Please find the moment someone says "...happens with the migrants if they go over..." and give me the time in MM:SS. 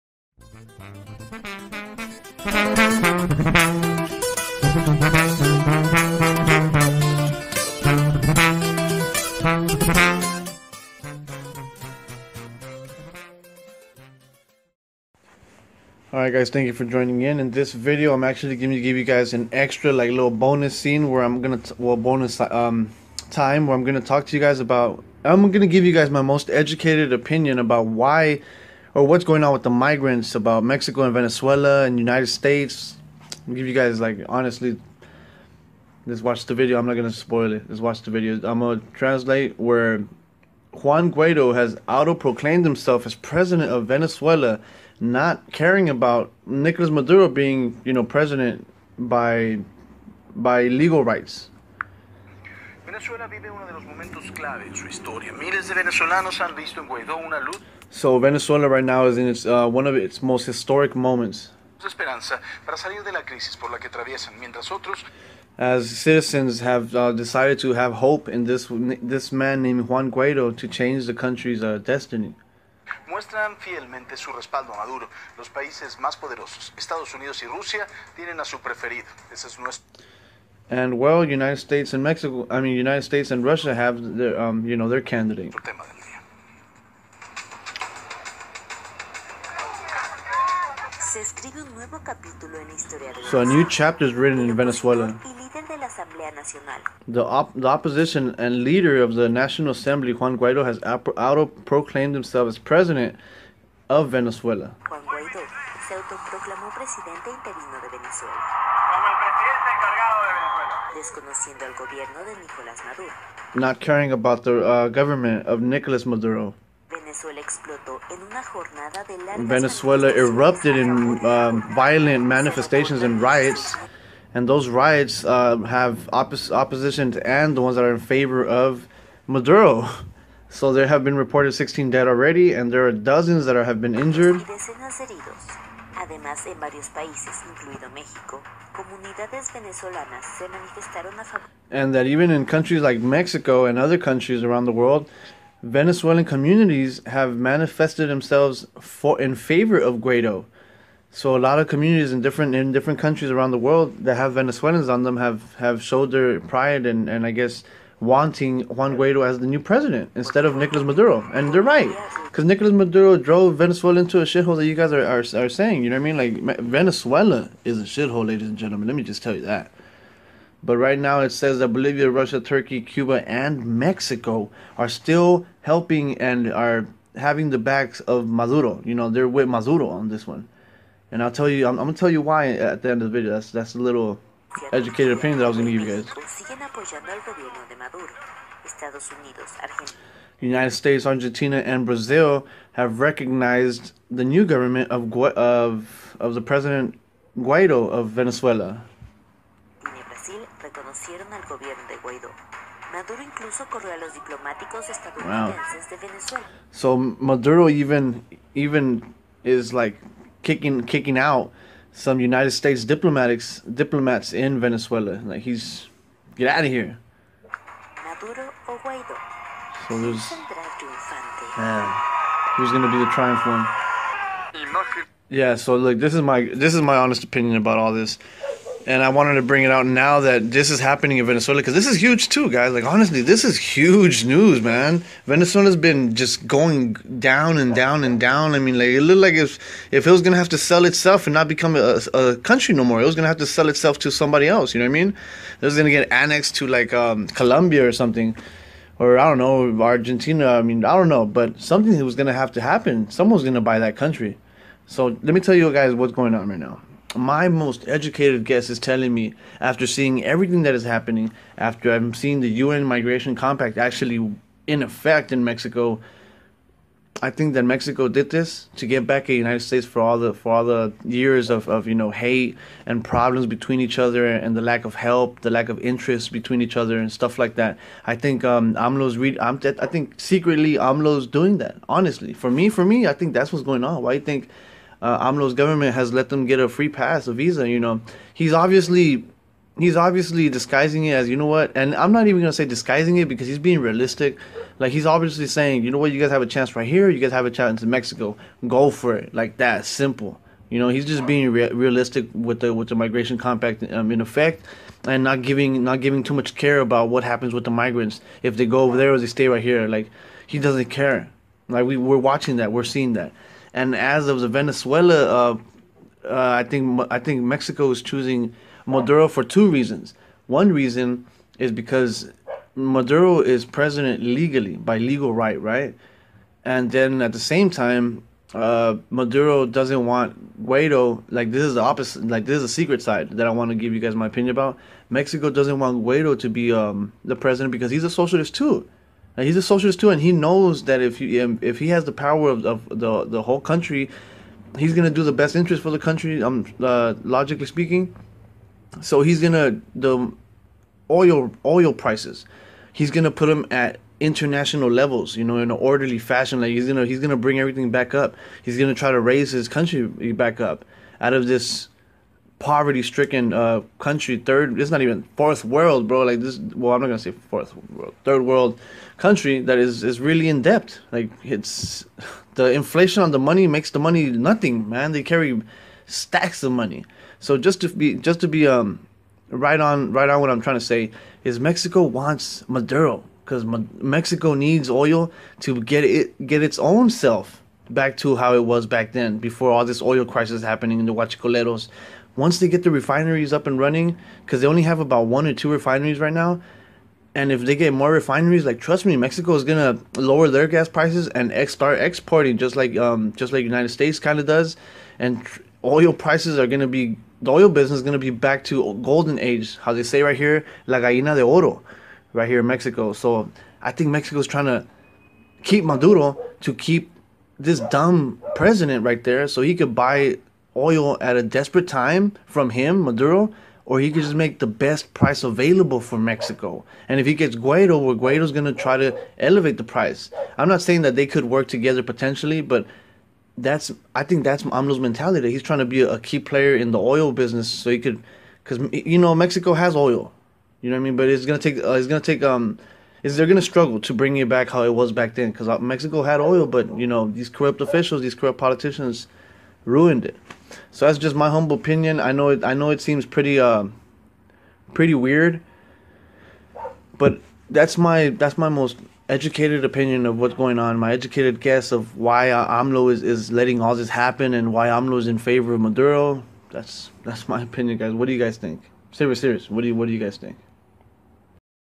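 05:07.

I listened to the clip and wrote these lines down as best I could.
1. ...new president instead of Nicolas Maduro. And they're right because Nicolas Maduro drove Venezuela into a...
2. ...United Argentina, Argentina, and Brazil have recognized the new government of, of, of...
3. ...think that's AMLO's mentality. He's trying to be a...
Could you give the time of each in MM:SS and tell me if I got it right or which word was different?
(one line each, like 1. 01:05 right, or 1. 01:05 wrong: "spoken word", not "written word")
1. 02:39 right
2. 03:10 wrong: "States", not "Argentina"
3. 07:14 right.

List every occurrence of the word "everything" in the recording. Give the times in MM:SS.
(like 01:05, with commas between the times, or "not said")
04:20, 05:57.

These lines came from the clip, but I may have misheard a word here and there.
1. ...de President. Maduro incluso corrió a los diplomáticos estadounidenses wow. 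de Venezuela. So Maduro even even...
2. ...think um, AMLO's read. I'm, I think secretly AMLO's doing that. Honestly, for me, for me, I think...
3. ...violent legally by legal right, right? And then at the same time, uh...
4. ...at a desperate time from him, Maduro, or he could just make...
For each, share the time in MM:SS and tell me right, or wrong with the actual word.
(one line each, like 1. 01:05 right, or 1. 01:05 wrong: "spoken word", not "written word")
1. 03:21 wrong: "Guaidó", not "President"
2. 04:38 right
3. 05:23 wrong: "president", not "violent"
4. 07:01 right.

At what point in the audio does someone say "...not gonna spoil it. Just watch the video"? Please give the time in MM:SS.
00:36.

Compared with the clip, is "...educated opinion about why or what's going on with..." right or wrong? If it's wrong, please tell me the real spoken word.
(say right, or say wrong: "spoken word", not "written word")
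right.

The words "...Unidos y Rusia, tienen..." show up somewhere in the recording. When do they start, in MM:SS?
01:17.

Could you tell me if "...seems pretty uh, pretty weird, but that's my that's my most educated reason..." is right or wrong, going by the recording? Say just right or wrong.
wrong.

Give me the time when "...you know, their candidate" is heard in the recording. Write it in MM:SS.
01:24.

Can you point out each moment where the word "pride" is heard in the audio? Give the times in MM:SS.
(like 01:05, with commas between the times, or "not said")
02:36.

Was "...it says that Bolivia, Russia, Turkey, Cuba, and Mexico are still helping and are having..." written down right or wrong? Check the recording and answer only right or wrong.
right.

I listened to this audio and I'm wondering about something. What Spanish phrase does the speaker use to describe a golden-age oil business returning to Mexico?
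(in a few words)
la gallina de oro.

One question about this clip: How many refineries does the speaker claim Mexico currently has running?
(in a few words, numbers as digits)
1 or 2.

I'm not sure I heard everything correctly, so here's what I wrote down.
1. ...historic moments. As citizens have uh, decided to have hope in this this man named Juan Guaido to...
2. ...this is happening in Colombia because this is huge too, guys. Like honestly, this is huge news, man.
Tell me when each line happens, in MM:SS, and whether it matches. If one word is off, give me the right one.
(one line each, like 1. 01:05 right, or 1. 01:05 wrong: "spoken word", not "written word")
1. 01:00 right
2. 03:50 wrong: "Venezuela", not "Colombia".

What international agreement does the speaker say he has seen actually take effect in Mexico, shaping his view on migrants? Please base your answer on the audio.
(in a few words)
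UN Migration Compact.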